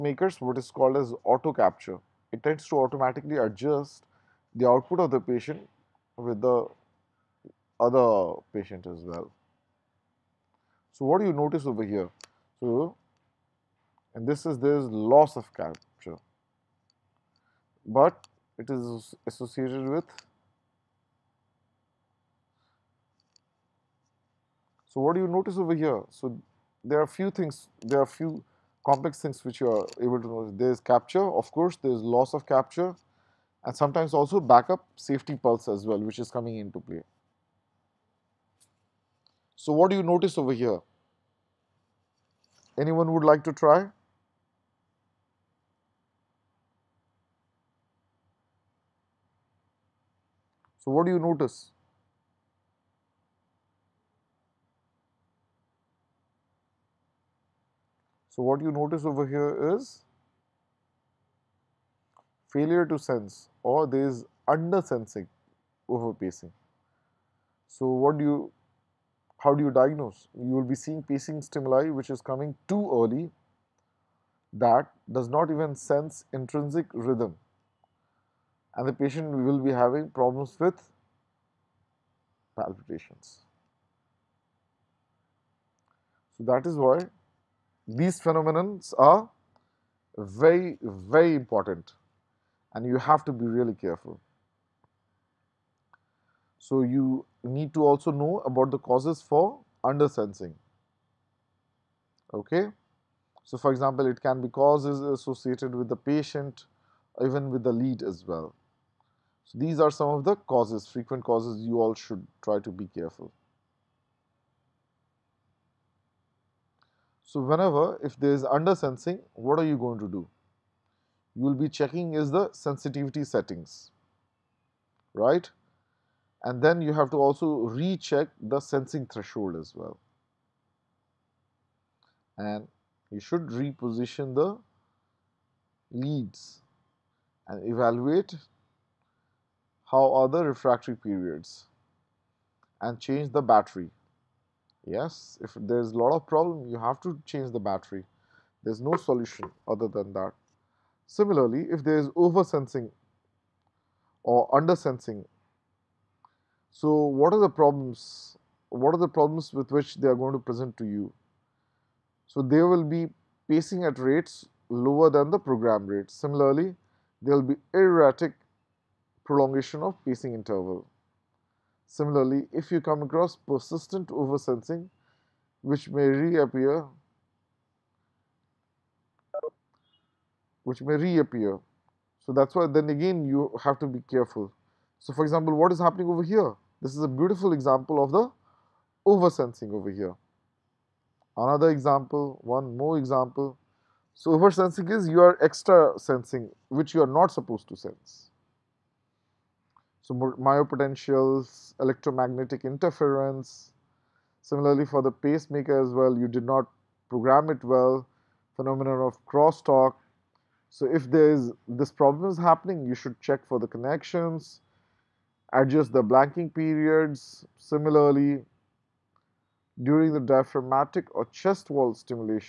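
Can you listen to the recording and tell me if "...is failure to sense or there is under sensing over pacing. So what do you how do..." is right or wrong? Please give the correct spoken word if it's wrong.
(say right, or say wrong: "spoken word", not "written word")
right.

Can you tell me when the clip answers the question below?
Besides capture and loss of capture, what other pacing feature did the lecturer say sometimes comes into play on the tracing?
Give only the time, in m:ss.
0:34.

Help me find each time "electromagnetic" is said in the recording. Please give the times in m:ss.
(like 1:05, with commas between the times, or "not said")
3:21.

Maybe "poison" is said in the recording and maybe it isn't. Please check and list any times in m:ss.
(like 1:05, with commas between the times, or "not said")
not said.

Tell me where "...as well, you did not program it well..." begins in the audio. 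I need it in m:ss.
3:25.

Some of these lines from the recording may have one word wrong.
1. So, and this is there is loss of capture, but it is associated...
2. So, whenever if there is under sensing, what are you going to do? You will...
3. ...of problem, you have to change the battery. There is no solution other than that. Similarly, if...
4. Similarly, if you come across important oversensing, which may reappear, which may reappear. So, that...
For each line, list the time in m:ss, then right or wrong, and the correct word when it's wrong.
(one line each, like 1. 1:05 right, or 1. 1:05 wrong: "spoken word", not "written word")
1. 0:12 right
2. 1:57 right
3. 2:26 right
4. 2:51 wrong: "persistent", not "important".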